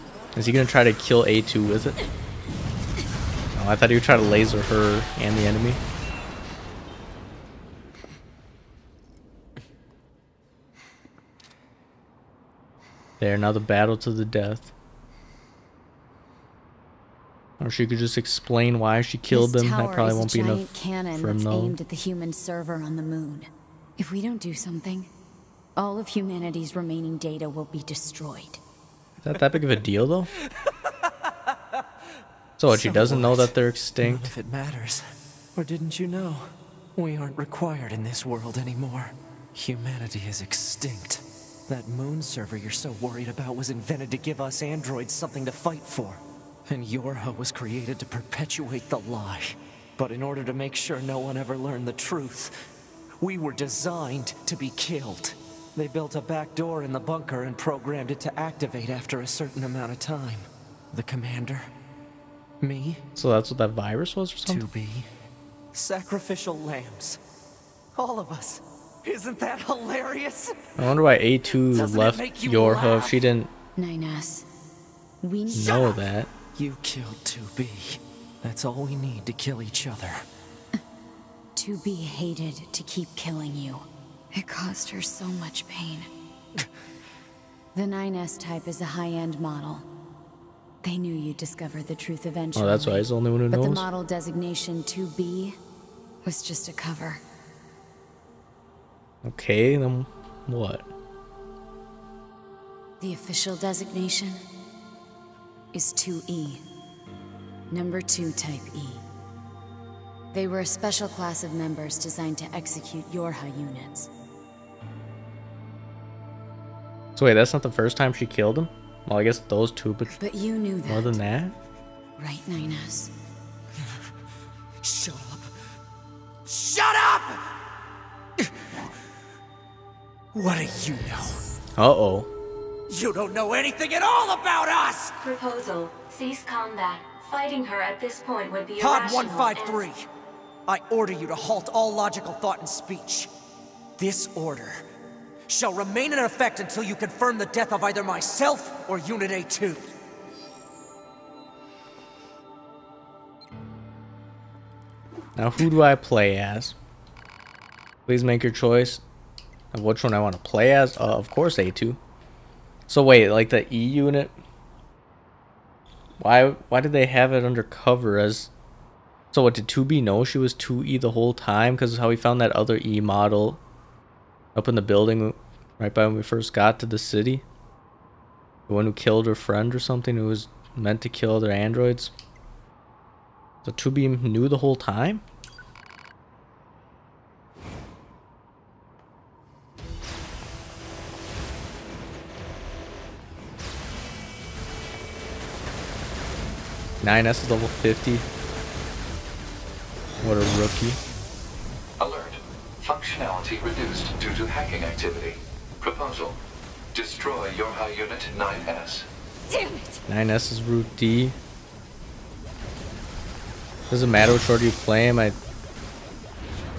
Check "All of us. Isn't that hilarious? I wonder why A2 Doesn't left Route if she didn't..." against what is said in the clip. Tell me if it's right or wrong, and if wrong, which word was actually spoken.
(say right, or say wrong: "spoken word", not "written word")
wrong: "Yorha", not "Route".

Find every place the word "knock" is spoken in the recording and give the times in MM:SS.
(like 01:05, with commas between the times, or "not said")
not said.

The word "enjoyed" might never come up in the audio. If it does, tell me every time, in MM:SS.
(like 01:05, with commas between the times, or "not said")
not said.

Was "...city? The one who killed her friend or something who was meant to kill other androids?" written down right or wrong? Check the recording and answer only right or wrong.
right.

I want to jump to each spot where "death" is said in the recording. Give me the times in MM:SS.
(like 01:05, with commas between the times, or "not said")
00:14, 02:27.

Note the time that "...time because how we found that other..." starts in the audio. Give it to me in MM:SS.
02:51.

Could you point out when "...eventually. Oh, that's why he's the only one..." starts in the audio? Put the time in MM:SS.
01:32.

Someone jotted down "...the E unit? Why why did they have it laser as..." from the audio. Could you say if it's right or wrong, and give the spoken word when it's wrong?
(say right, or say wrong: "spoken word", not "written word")
wrong: "undercover", not "laser".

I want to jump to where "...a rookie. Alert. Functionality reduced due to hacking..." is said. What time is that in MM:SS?
03:20.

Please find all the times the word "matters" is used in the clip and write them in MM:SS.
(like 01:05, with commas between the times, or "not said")
00:34, 03:34.